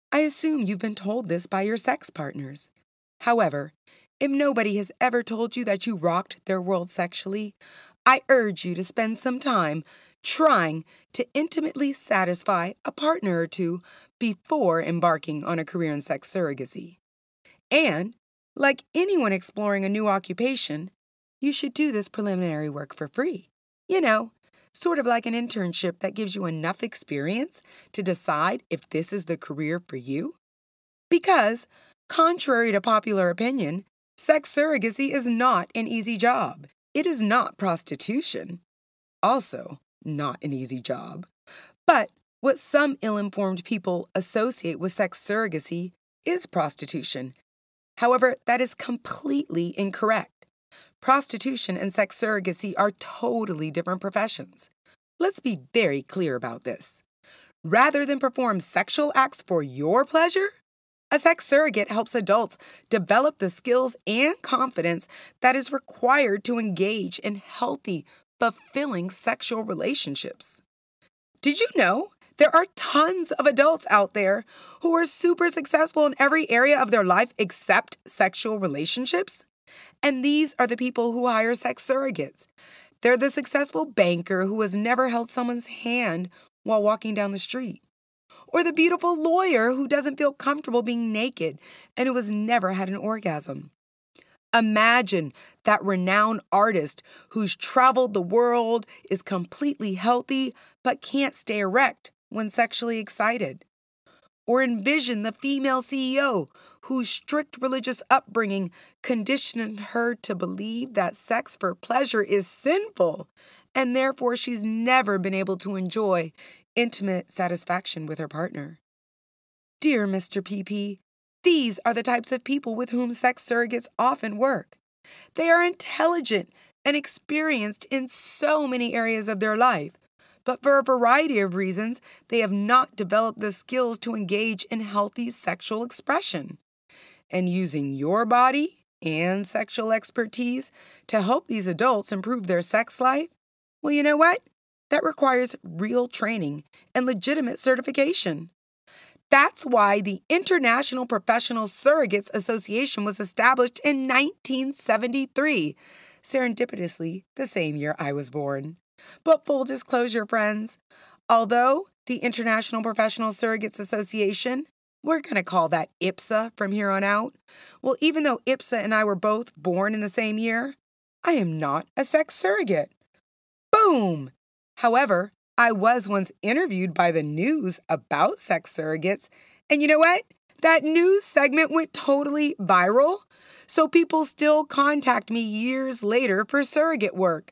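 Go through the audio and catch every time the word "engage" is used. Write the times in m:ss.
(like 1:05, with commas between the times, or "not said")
1:06, 2:14.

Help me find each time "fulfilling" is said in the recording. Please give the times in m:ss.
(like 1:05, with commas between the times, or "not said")
1:08.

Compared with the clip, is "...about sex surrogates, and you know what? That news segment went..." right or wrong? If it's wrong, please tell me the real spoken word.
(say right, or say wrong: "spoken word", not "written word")
right.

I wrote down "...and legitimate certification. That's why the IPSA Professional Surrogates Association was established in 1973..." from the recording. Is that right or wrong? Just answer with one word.
wrong.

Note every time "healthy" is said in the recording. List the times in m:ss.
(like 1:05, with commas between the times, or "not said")
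1:07, 1:39, 2:14.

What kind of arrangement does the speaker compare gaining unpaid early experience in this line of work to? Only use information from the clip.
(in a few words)
internship.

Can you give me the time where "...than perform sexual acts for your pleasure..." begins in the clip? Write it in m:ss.
0:58.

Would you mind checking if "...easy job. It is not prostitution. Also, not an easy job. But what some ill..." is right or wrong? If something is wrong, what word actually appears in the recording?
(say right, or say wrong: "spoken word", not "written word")
right.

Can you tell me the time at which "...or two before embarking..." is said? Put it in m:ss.
0:13.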